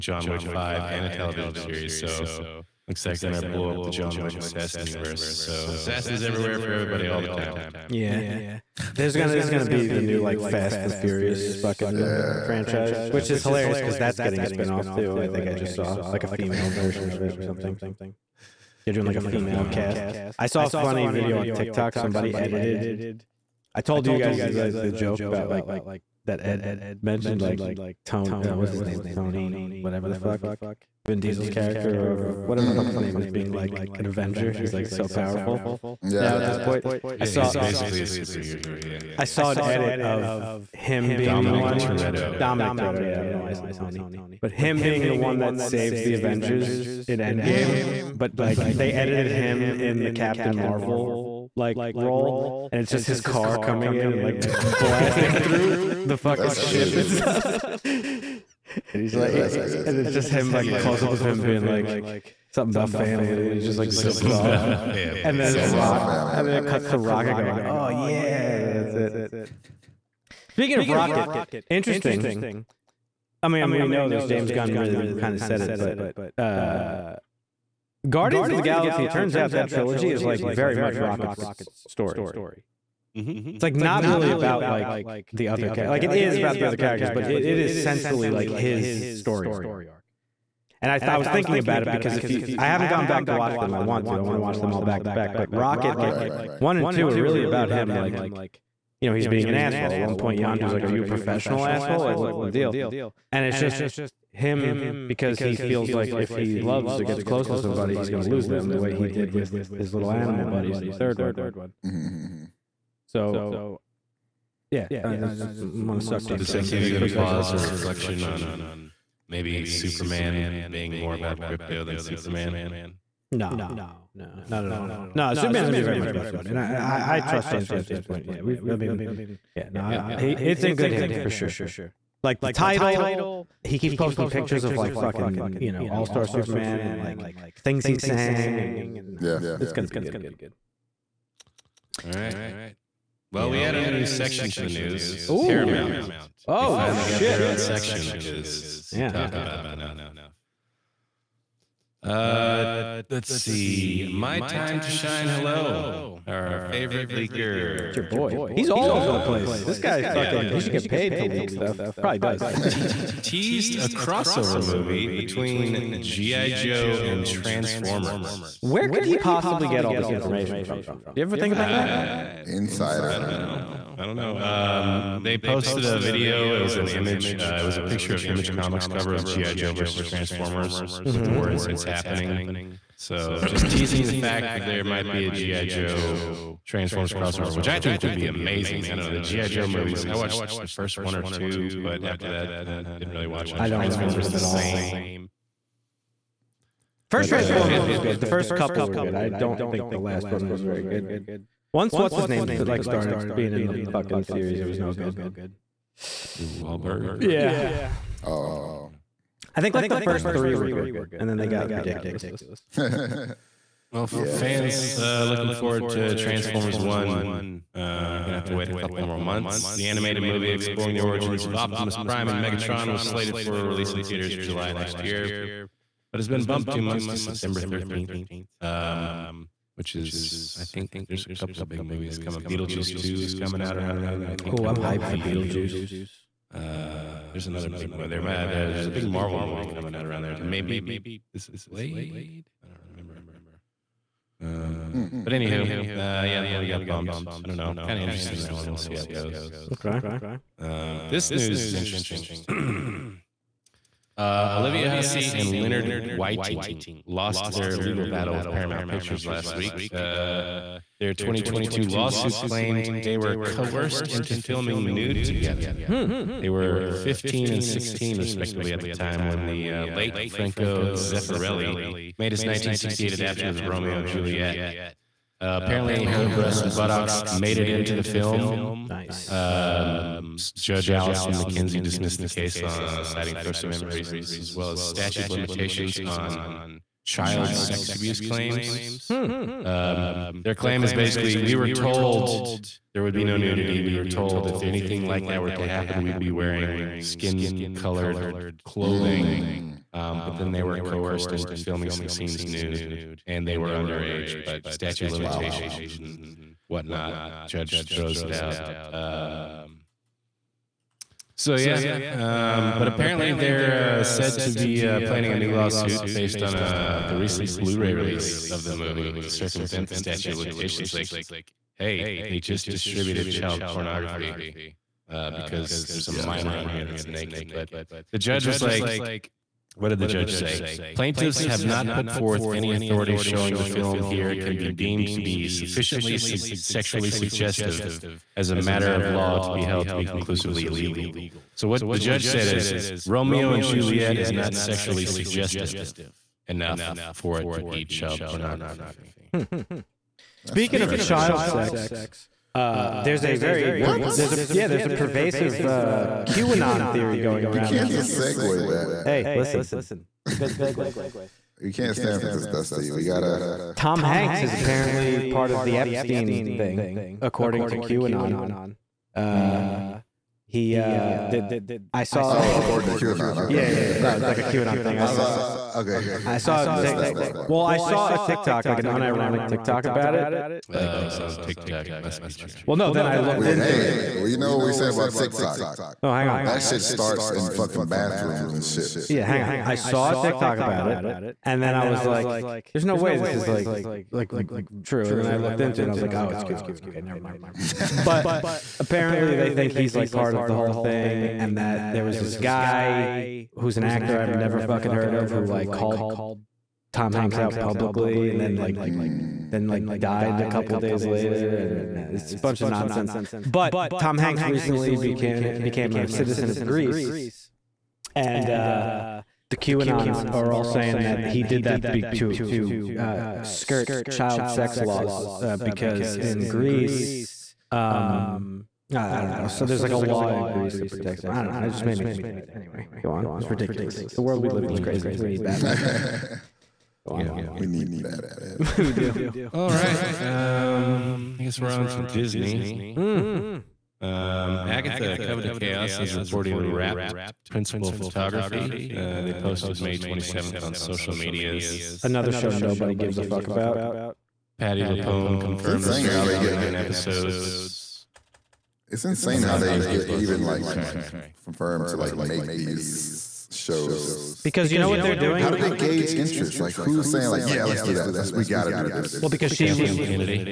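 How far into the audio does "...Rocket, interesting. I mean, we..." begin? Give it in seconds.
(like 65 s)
70 s.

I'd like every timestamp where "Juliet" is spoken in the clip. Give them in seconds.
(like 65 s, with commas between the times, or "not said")
274 s, 343 s.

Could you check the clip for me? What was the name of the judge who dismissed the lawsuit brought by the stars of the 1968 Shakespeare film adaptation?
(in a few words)
Allison McKenzie.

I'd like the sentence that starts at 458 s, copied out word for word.
It's insane how they Disney get Plus.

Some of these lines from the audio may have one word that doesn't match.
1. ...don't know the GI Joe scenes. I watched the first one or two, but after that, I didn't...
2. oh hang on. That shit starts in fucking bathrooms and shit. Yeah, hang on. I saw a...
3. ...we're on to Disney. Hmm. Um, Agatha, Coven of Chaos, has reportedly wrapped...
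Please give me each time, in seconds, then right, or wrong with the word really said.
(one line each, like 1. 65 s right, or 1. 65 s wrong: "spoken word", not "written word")
1. 188 s wrong: "movies", not "scenes"
2. 386 s right
3. 441 s right.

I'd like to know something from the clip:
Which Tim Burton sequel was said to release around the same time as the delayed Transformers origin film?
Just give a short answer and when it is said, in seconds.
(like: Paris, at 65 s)
Beetlejuice 2, at 232 s.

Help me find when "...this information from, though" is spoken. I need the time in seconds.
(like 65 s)
169 s.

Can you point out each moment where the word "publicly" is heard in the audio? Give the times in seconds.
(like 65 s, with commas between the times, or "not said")
407 s.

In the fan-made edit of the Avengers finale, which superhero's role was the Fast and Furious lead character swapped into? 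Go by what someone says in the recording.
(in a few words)
Captain Marvel.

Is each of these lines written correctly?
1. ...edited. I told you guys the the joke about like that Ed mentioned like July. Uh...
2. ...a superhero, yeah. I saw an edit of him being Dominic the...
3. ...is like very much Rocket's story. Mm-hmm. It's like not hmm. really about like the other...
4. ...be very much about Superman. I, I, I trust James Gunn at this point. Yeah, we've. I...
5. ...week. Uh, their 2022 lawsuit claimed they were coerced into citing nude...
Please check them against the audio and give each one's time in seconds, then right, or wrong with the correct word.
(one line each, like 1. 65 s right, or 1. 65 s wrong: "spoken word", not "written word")
1. 22 s wrong: "Tony", not "July"
2. 38 s right
3. 80 s right
4. 125 s right
5. 259 s wrong: "filming", not "citing".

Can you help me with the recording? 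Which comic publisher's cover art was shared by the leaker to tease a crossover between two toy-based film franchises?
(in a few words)
Image Comics.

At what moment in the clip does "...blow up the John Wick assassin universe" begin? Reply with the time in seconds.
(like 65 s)
3 s.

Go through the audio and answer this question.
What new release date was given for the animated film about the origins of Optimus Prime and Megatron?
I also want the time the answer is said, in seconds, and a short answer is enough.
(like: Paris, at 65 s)
September 13, at 227 s.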